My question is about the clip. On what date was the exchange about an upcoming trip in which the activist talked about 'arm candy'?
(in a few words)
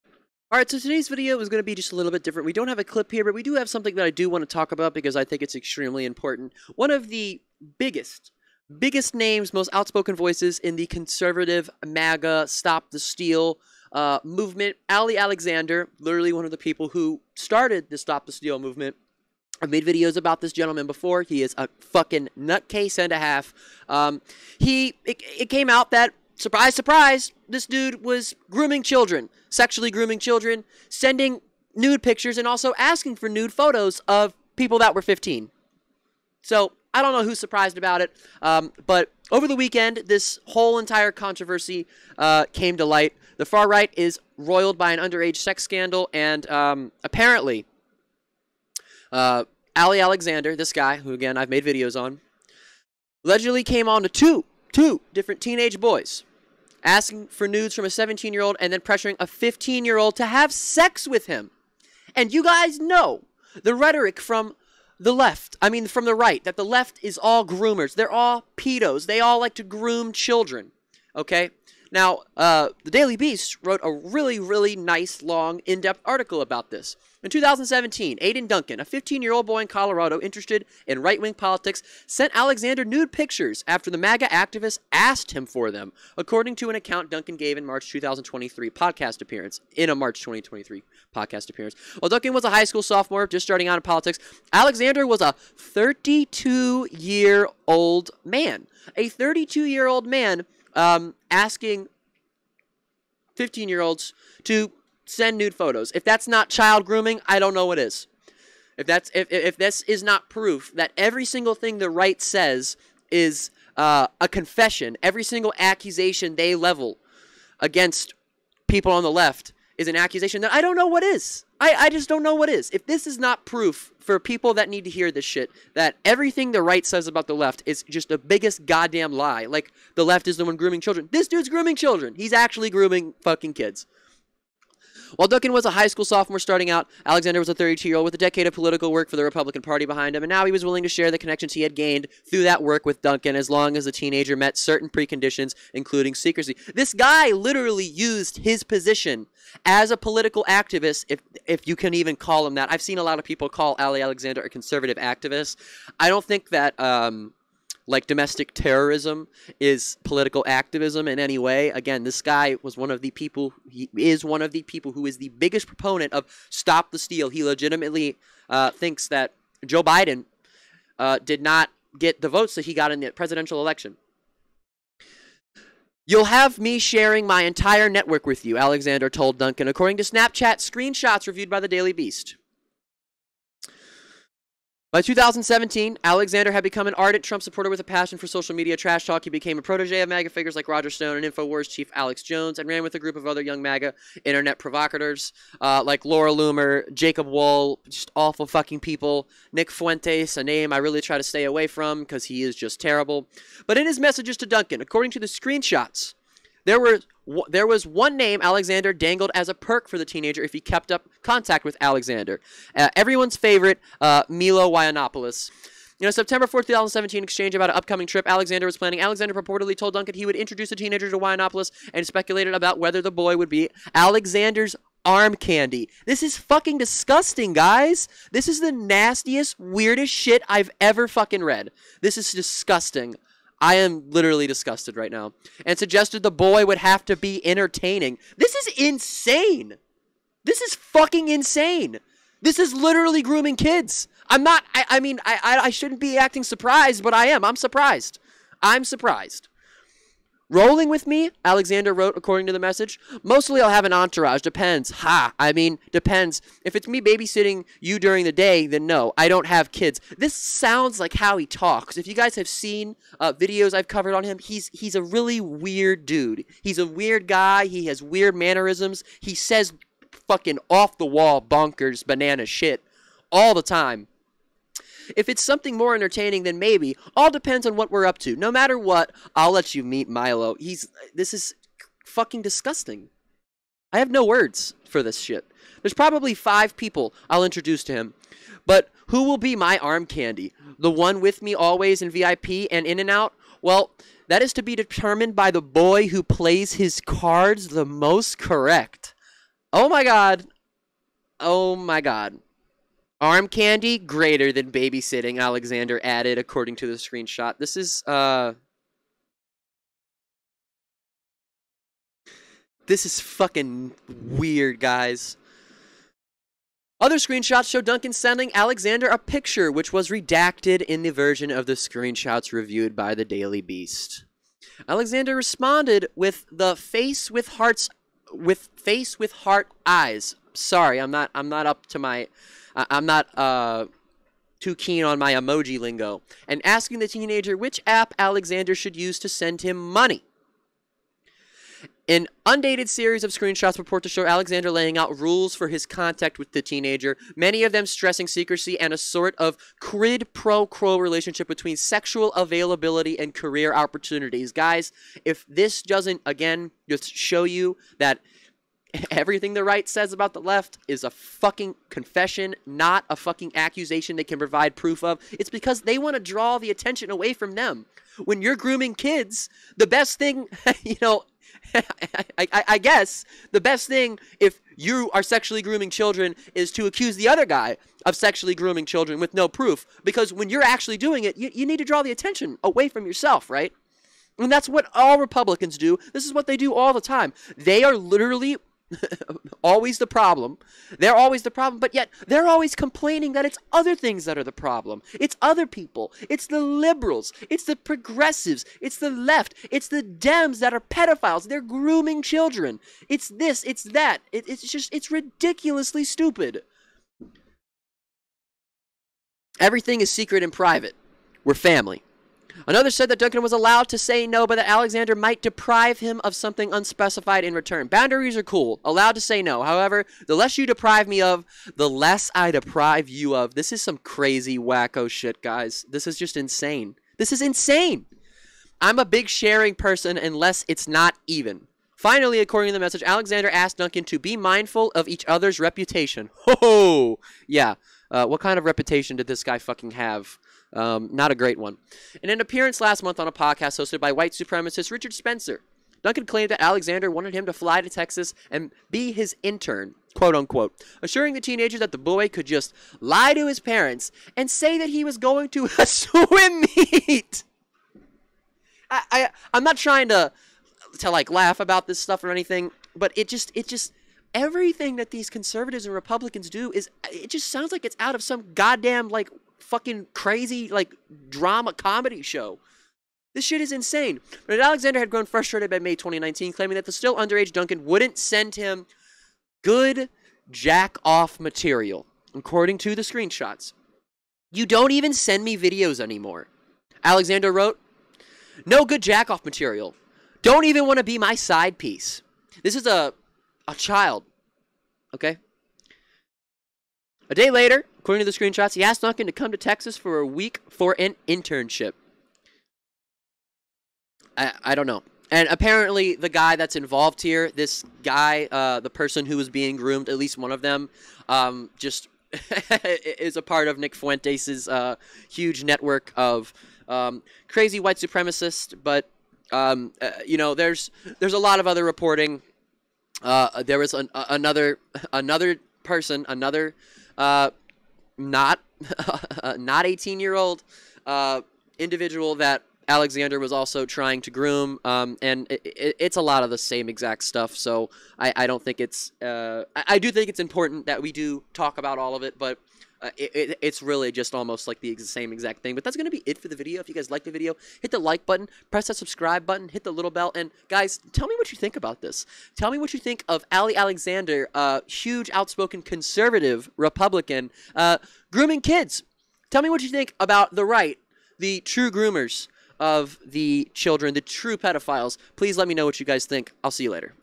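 September 4, 2017.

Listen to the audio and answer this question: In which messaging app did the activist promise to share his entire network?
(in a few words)
Snapchat.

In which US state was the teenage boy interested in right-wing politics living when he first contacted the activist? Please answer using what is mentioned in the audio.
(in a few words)
Colorado.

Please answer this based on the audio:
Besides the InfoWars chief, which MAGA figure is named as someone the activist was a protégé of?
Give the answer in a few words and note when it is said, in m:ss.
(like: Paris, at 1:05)
Roger Stone, at 3:10.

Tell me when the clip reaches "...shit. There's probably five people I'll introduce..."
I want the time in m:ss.
4:45.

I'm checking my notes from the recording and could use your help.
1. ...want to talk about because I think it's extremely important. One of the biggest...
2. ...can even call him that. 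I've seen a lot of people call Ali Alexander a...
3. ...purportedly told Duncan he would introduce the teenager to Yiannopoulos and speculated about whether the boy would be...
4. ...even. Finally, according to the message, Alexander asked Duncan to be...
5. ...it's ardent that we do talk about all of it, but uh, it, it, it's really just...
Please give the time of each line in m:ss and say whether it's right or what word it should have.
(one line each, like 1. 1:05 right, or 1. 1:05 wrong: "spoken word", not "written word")
1. 0:04 right
2. 2:31 right
3. 3:39 right
4. 7:11 right
5. 9:00 wrong: "important", not "ardent".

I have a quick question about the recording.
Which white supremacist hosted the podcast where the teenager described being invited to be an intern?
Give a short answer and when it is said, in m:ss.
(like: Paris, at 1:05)
Richard Spencer, at 7:24.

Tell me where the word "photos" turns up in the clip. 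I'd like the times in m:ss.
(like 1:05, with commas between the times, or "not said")
0:33, 1:45.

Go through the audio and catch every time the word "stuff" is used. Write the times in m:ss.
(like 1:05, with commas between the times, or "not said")
7:41, 8:57.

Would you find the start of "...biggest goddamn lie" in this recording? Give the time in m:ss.
2:08.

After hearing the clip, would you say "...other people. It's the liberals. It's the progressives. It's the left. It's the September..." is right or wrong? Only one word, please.
wrong.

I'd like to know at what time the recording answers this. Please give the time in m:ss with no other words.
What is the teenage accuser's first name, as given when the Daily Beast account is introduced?
1:18.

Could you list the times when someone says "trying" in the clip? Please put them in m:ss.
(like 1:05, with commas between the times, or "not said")
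7:39, 8:53.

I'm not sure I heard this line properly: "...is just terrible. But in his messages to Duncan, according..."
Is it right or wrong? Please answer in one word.
right.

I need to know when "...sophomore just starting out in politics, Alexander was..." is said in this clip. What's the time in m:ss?
1:32.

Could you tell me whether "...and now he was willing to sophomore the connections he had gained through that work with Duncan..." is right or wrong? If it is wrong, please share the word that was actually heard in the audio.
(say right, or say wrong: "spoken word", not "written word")
wrong: "share", not "sophomore".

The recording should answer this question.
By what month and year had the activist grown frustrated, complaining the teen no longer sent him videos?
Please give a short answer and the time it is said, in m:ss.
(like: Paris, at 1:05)
May 2019, at 7:55.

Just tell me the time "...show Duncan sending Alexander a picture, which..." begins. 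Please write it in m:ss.
5:17.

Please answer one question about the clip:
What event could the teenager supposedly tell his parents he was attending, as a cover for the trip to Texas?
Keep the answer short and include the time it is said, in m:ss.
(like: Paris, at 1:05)
A swim meet, at 7:35.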